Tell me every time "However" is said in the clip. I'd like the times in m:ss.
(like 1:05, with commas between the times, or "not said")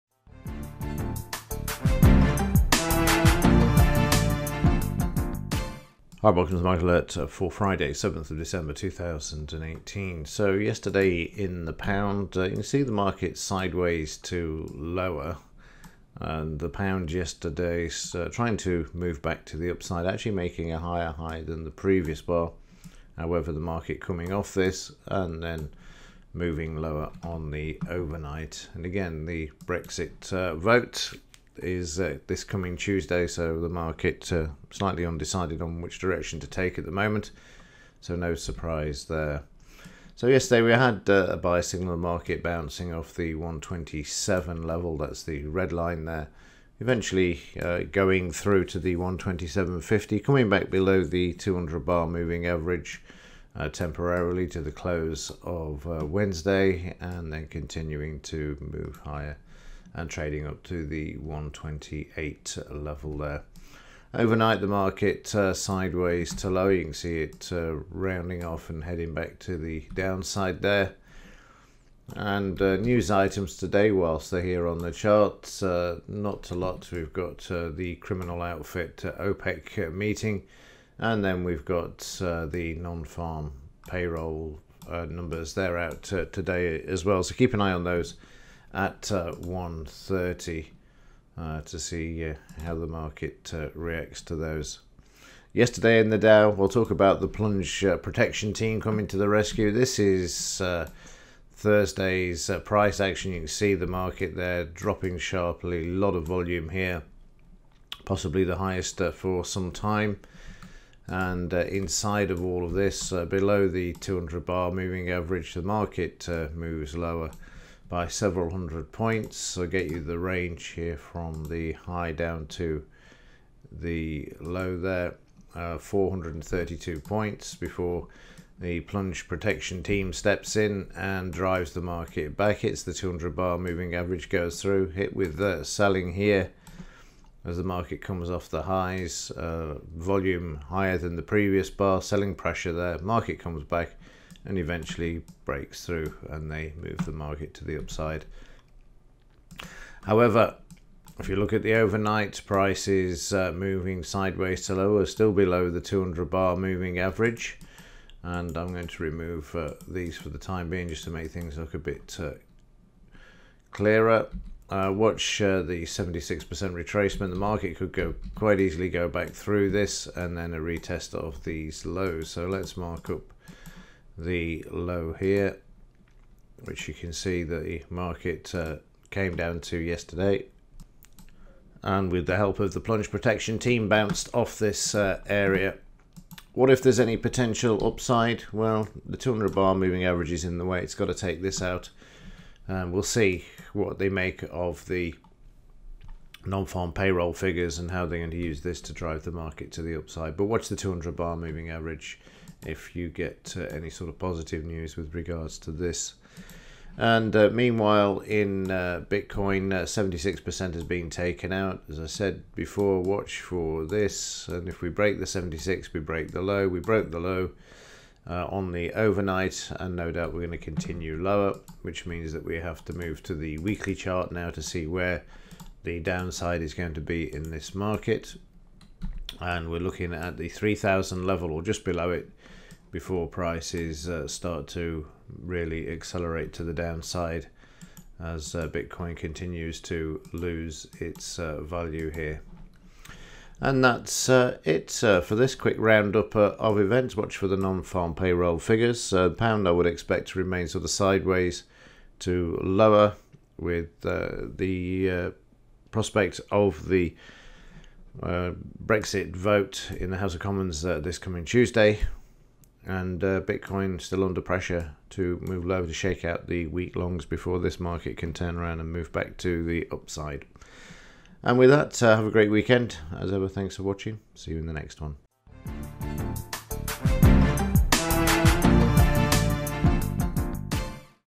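0:23, 2:30.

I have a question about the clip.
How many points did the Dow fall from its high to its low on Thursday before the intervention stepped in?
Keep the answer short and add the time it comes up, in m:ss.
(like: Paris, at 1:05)
432, at 2:05.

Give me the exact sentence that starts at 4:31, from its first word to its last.
And with that, uh, have a great weekend.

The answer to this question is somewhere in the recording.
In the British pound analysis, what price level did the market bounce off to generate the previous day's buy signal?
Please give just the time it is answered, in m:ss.
0:43.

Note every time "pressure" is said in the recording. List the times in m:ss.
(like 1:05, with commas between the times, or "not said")
2:22, 4:24.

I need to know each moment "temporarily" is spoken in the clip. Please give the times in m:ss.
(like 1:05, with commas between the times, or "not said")
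0:53.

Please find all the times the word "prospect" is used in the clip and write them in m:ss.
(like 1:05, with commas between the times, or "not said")
4:15.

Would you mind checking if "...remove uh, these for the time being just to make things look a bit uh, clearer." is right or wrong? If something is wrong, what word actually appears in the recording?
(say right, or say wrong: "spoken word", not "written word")
right.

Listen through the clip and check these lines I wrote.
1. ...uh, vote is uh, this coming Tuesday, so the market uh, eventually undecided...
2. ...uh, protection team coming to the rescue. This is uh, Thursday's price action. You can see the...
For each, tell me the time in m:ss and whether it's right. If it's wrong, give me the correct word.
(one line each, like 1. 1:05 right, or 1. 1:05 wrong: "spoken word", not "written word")
1. 0:30 wrong: "slightly", not "eventually"
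2. 1:37 right.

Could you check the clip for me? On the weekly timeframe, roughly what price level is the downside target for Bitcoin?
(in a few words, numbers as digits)
3000.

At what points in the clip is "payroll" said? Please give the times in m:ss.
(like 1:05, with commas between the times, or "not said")
1:23, 3:16, 4:08.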